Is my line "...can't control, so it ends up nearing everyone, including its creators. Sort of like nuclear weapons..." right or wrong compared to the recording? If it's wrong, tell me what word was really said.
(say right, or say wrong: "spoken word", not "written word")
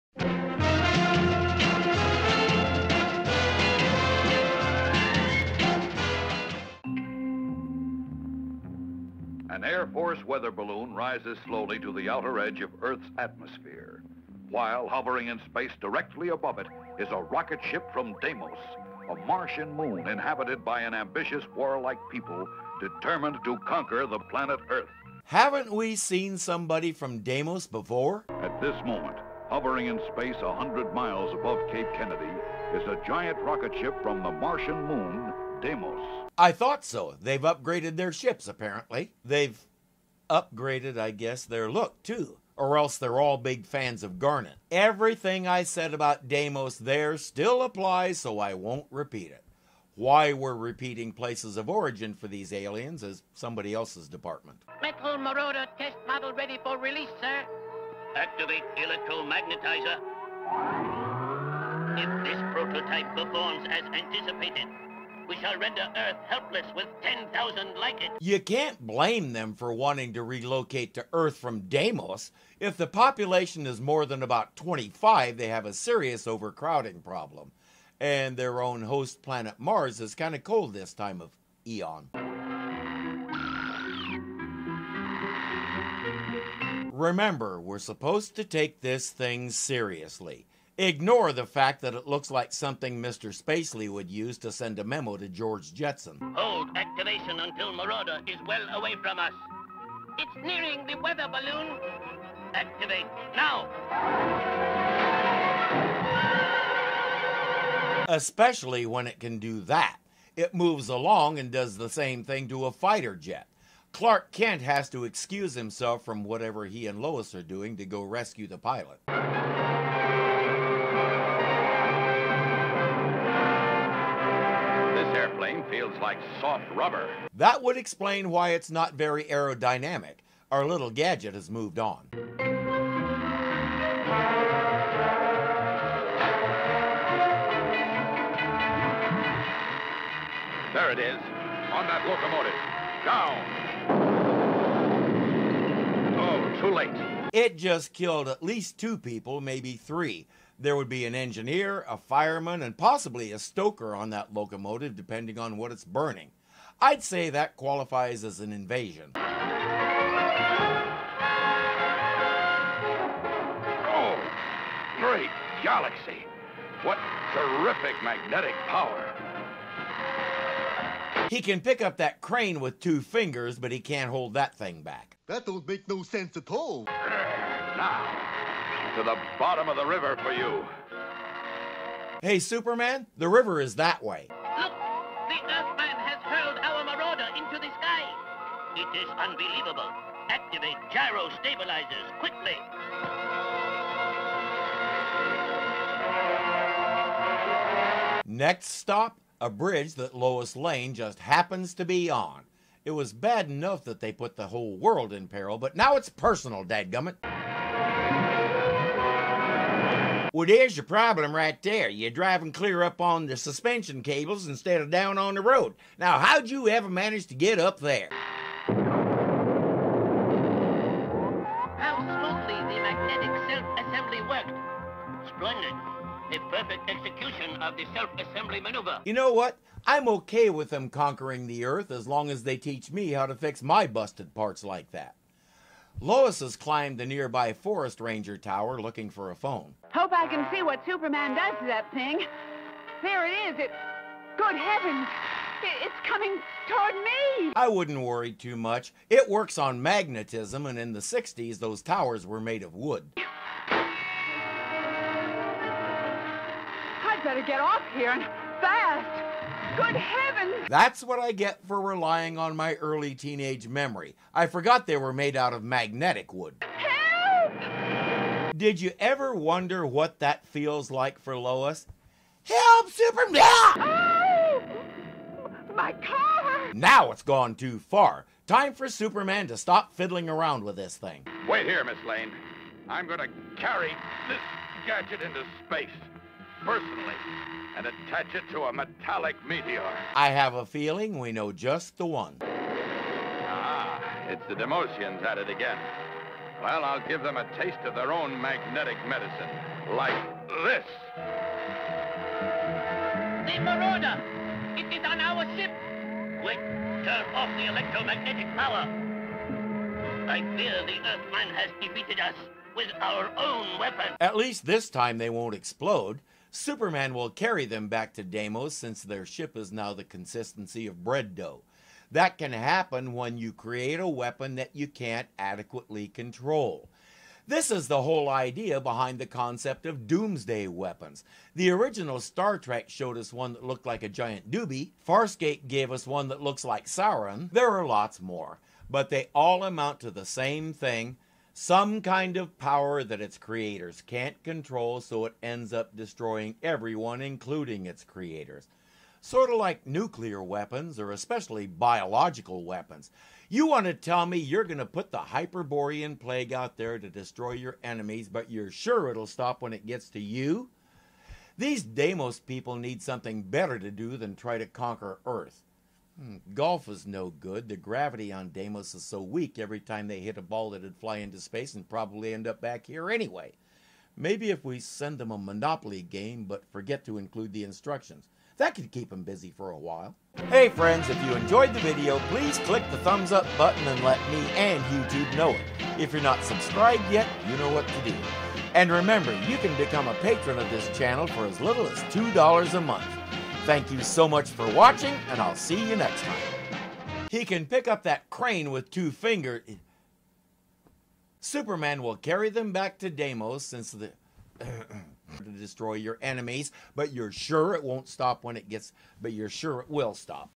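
wrong: "destroying", not "nearing".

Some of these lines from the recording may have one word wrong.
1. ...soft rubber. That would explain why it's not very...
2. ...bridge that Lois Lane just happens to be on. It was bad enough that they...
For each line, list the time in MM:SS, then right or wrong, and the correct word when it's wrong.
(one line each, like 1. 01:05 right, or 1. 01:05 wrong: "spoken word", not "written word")
1. 02:06 right
2. 03:19 right.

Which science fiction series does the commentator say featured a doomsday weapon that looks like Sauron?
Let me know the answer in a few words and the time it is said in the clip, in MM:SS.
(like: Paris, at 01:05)
Farscape, at 05:35.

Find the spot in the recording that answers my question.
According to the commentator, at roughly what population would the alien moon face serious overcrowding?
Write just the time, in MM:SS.
01:14.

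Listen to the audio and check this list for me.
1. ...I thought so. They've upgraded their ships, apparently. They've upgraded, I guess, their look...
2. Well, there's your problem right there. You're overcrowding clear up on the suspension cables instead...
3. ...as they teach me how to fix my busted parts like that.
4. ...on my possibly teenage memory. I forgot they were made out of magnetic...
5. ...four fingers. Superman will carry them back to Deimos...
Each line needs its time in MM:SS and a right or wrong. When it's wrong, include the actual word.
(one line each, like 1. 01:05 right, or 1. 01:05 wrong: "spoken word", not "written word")
1. 00:36 right
2. 03:30 wrong: "driving", not "overcrowding"
3. 03:52 right
4. 04:22 wrong: "early", not "possibly"
5. 06:38 wrong: "two", not "four".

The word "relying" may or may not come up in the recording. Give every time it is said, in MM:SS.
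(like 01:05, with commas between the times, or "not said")
04:21.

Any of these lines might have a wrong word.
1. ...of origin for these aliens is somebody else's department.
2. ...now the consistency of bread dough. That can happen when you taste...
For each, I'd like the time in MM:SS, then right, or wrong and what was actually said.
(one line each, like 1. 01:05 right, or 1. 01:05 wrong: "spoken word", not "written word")
1. 00:51 right
2. 05:19 wrong: "create", not "taste".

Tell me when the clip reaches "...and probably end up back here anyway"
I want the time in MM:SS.
06:11.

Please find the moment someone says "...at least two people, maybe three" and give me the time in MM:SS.
02:28.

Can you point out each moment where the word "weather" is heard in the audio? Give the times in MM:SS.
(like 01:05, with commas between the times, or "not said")
00:10, 01:40.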